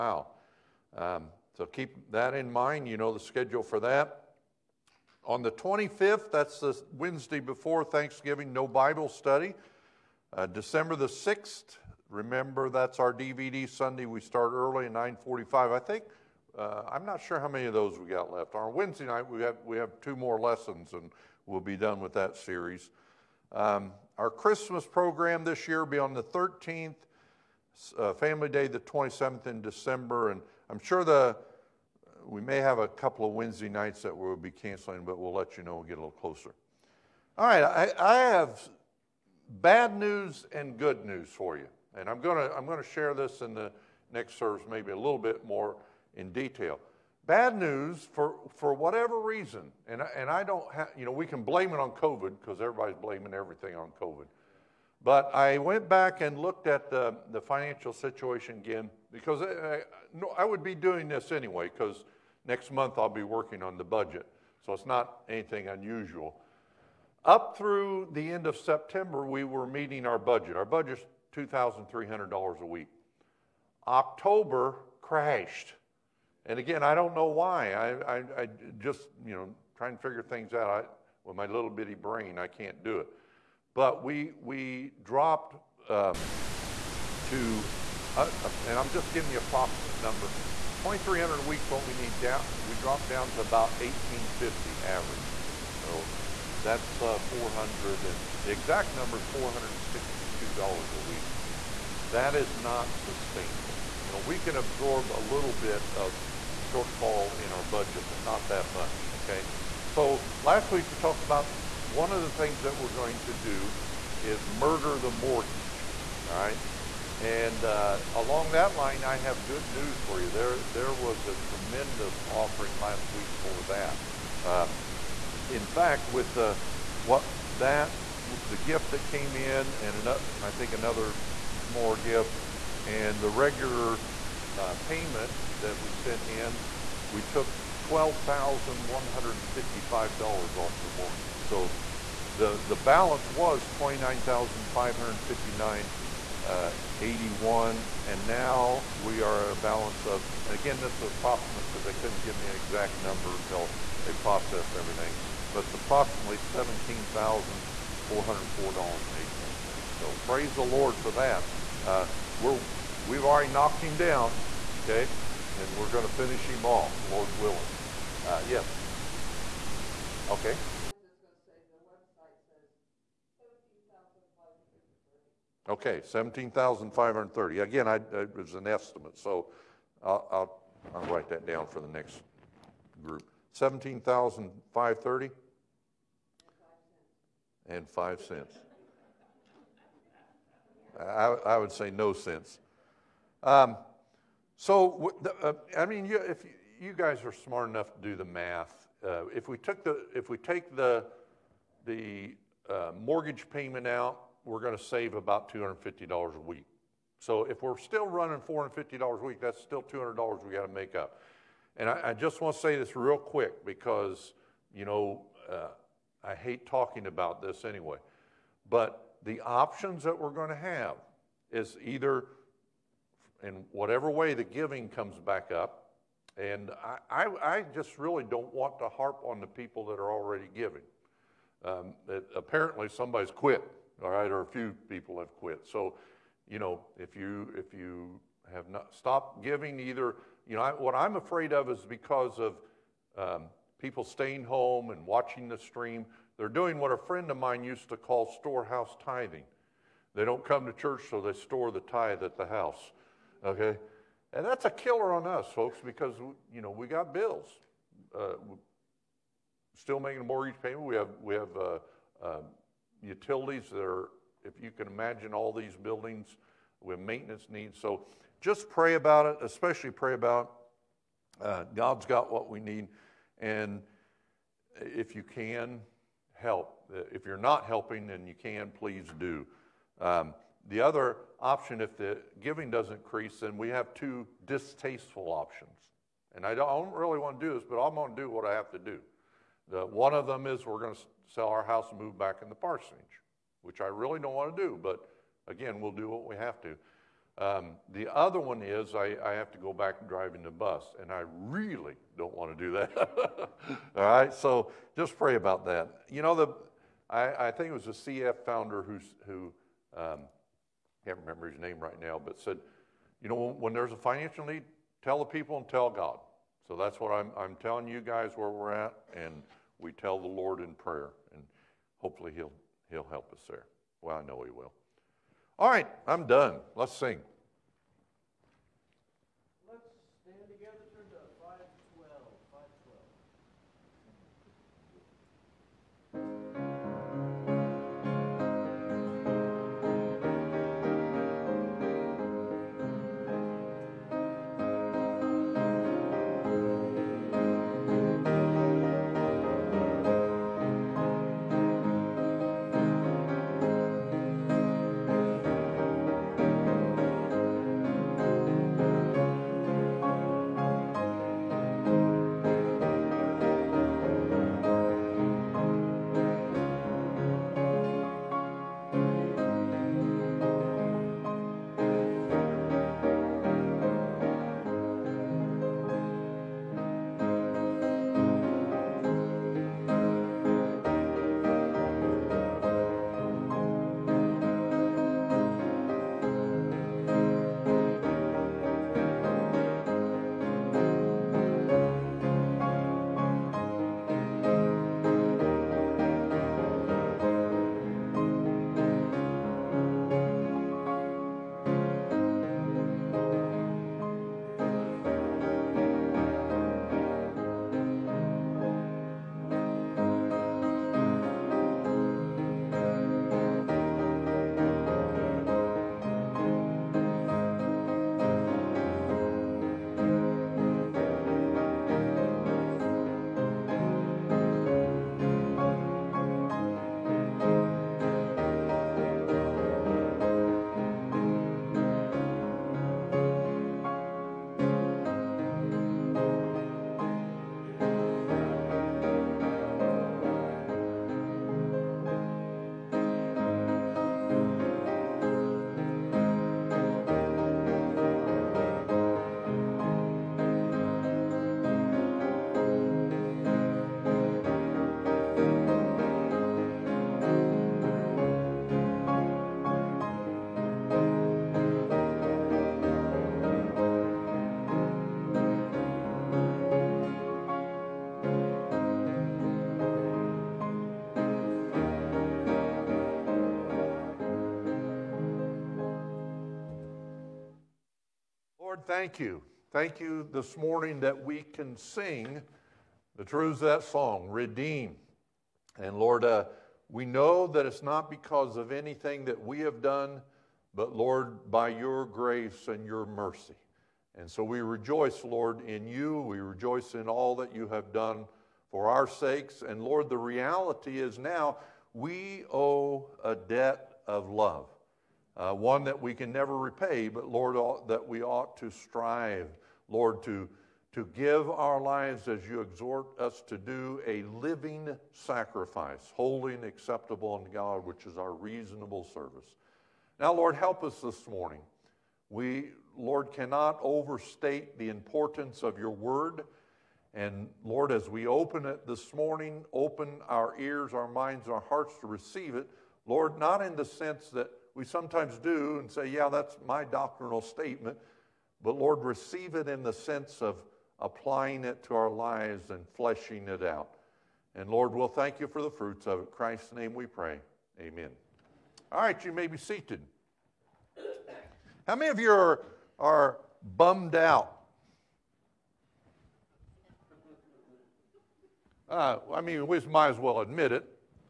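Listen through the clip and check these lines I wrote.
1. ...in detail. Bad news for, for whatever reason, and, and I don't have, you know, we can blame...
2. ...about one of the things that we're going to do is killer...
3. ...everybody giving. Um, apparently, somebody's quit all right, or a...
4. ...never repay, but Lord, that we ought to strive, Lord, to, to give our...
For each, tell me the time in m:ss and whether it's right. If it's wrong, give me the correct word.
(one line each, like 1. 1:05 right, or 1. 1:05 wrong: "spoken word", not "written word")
1. 0:46 right
2. 1:51 wrong: "murder", not "killer"
3. 3:50 wrong: "already", not "everybody"
4. 8:26 right.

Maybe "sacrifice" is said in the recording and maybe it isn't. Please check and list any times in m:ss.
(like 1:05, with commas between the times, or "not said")
8:35.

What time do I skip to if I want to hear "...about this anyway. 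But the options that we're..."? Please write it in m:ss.
3:37.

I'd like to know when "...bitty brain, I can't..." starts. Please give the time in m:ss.
1:21.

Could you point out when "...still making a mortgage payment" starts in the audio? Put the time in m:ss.
4:19.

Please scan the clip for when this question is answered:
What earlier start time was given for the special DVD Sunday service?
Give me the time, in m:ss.
0:14.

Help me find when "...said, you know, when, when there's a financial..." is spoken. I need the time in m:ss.
5:12.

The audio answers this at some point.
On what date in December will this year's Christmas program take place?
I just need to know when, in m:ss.
0:26.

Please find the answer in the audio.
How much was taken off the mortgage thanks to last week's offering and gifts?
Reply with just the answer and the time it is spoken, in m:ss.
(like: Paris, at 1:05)
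$12,155, at 2:17.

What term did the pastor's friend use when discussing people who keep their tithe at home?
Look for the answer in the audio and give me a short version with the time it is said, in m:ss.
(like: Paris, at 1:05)
storehouse tithing, at 4:08.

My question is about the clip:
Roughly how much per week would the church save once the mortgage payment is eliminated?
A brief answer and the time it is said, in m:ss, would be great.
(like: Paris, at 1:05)
$250, at 3:25.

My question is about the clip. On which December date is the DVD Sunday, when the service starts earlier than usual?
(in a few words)
December 6.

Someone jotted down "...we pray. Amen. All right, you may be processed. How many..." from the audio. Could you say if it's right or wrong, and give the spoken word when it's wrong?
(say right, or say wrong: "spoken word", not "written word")
wrong: "seated", not "processed".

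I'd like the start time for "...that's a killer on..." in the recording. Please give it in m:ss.
4:14.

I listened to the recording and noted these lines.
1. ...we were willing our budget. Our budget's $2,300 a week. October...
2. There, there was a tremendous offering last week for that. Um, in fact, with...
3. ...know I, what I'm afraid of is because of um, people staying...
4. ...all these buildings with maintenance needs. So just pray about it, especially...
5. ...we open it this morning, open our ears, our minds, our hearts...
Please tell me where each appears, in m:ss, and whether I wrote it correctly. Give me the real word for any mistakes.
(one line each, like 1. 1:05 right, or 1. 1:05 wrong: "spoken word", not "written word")
1. 1:09 wrong: "meeting", not "willing"
2. 2:00 right
3. 4:00 right
4. 4:25 right
5. 8:48 right.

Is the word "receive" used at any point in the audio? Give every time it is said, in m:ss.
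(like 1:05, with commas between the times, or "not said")
8:52, 8:59.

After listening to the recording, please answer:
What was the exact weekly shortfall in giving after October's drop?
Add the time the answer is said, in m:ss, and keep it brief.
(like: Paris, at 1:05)
$462, at 1:39.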